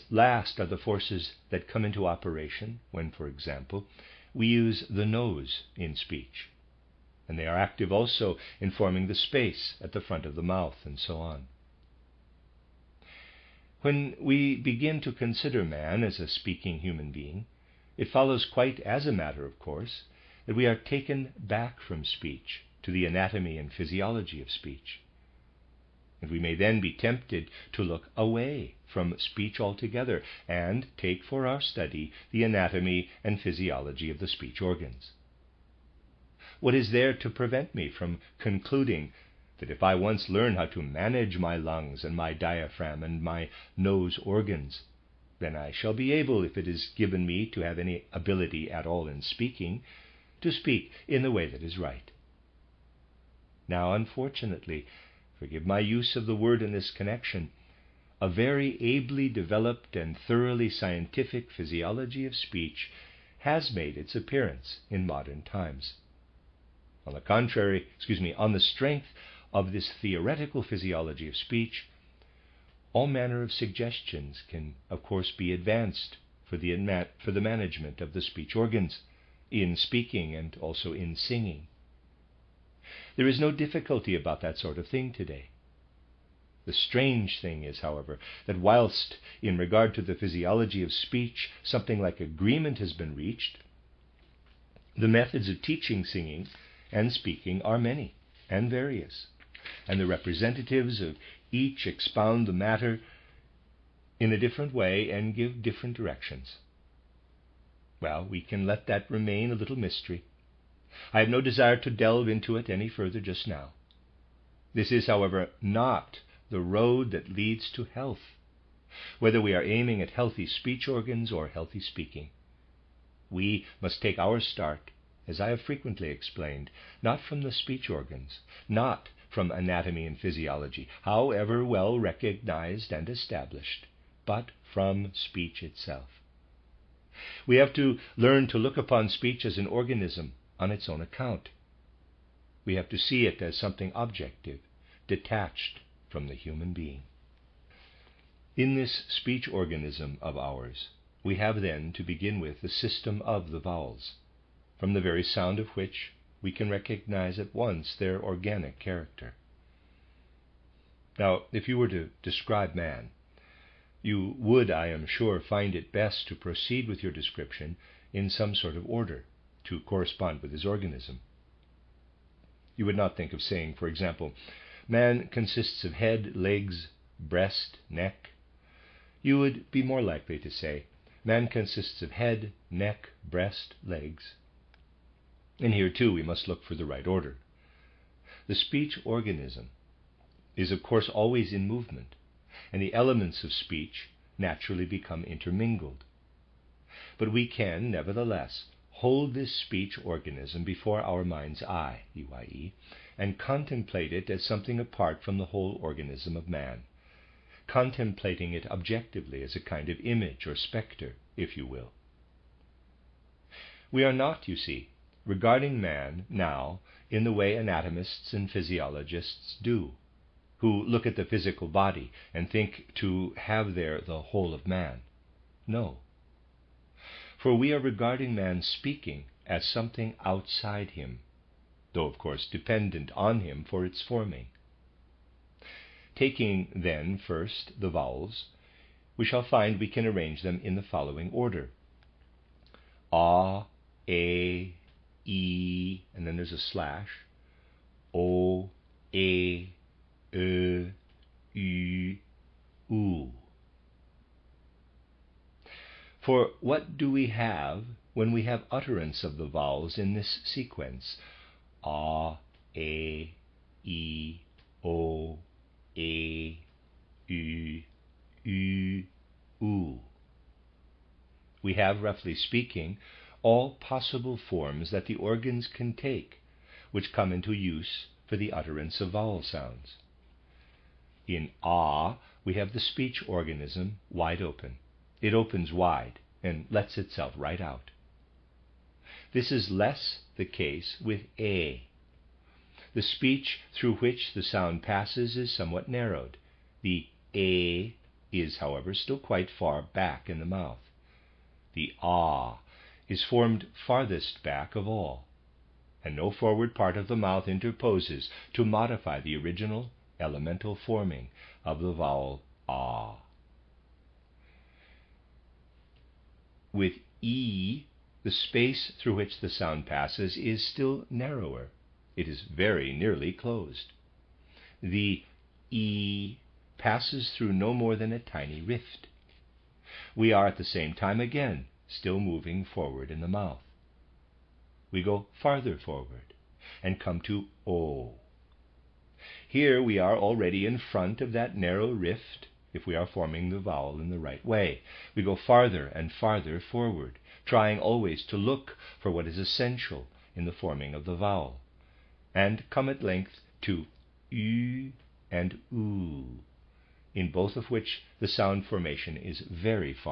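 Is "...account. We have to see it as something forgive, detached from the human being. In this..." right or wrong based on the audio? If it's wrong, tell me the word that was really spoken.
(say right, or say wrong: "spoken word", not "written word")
wrong: "objective", not "forgive".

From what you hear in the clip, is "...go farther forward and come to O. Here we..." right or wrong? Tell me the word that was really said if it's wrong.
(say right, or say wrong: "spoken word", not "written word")
right.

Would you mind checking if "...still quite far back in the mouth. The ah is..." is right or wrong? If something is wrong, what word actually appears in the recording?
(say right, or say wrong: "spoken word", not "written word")
right.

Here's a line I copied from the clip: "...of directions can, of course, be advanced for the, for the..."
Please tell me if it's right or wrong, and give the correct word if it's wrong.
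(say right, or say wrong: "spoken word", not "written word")
wrong: "suggestions", not "directions".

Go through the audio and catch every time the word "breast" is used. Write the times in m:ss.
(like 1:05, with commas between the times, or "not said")
2:57, 3:03.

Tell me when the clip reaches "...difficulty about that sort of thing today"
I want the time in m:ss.
1:23.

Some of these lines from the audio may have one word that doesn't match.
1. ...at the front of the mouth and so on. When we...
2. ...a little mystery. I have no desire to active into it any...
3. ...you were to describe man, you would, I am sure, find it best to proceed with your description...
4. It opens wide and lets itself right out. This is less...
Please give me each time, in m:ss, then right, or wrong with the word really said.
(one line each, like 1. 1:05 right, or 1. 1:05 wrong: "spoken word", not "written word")
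1. 0:09 right
2. 1:49 wrong: "delve", not "active"
3. 2:41 right
4. 4:45 right.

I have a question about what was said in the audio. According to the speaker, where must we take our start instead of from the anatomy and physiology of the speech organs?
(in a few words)
from speech itself.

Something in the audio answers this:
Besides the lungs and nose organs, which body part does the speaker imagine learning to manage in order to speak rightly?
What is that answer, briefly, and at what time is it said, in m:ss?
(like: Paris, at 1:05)
diaphragm, at 0:42.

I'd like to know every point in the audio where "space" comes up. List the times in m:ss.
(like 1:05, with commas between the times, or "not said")
0:09, 5:18.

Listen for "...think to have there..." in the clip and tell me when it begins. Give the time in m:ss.
3:42.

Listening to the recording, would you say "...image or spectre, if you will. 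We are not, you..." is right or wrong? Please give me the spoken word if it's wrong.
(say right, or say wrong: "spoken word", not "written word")
right.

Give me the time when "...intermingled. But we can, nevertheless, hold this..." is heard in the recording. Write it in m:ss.
3:15.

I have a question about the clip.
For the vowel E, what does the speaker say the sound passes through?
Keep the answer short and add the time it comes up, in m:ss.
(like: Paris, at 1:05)
a tiny rift, at 5:28.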